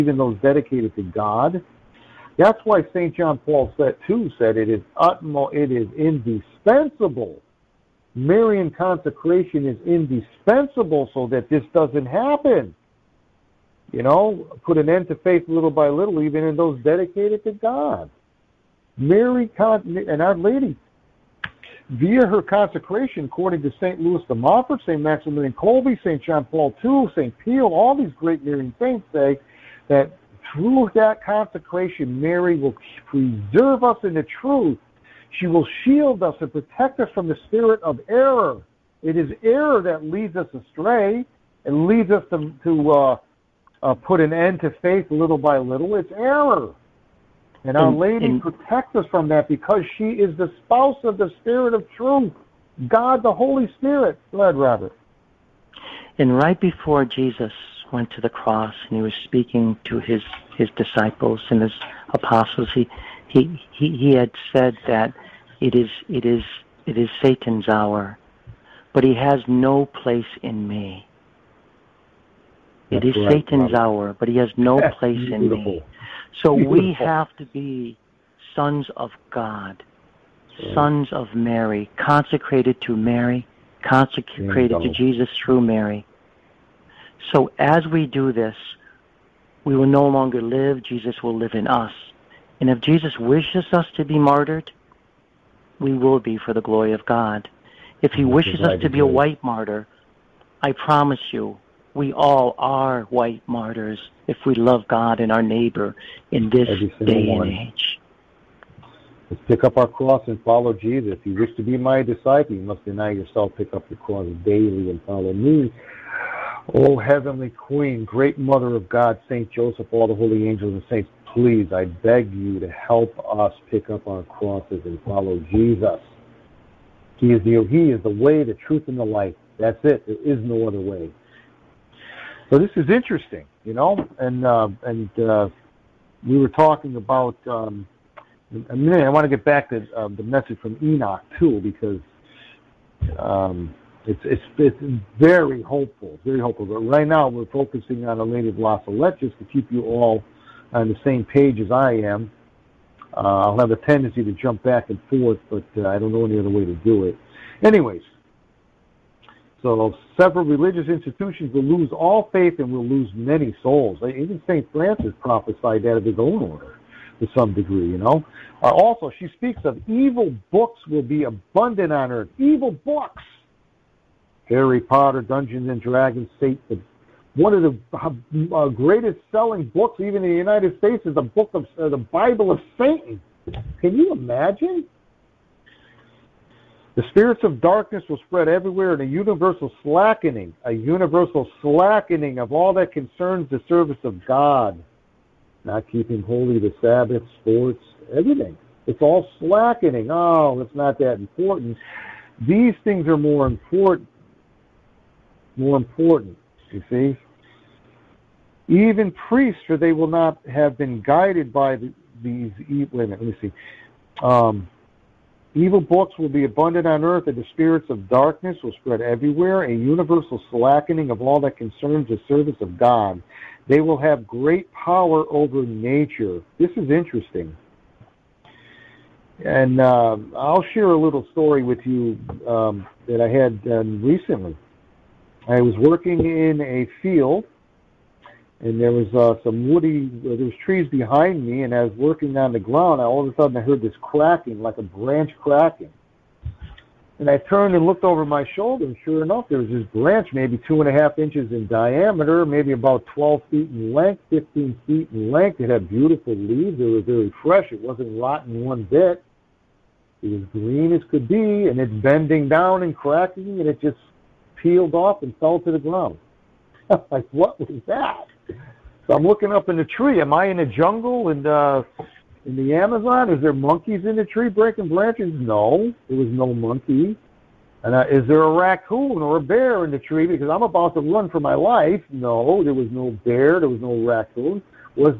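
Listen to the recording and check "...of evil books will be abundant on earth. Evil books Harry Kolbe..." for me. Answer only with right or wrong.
wrong.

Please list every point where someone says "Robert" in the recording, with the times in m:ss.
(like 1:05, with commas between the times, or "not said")
0:54, 1:13.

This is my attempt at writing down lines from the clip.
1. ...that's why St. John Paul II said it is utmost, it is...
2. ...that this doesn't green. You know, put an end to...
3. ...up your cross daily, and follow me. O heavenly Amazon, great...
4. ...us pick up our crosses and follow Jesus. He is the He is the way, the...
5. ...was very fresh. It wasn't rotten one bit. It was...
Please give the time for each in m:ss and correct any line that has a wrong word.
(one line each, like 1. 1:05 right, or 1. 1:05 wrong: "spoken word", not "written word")
1. 0:02 right
2. 0:11 wrong: "happen", not "green"
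3. 1:53 wrong: "Queen", not "Amazon"
4. 2:03 right
5. 4:16 right.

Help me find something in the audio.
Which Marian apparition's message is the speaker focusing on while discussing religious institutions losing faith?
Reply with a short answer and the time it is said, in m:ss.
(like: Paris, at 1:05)
La Salette, at 2:28.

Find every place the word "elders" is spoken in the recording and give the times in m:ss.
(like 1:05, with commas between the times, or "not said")
not said.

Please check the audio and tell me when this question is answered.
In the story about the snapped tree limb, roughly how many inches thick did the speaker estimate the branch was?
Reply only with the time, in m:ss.
4:10.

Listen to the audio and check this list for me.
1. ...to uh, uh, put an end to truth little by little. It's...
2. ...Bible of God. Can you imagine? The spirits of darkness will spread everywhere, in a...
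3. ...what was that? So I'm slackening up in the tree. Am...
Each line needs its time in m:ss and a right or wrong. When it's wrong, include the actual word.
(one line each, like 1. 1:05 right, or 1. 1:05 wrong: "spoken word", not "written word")
1. 0:42 wrong: "faith", not "truth"
2. 3:01 wrong: "Satan", not "God"
3. 4:27 wrong: "looking", not "slackening".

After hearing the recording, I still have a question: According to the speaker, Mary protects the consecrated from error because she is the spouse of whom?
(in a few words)
Spirit of Truth.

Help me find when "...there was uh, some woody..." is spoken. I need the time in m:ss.
3:58.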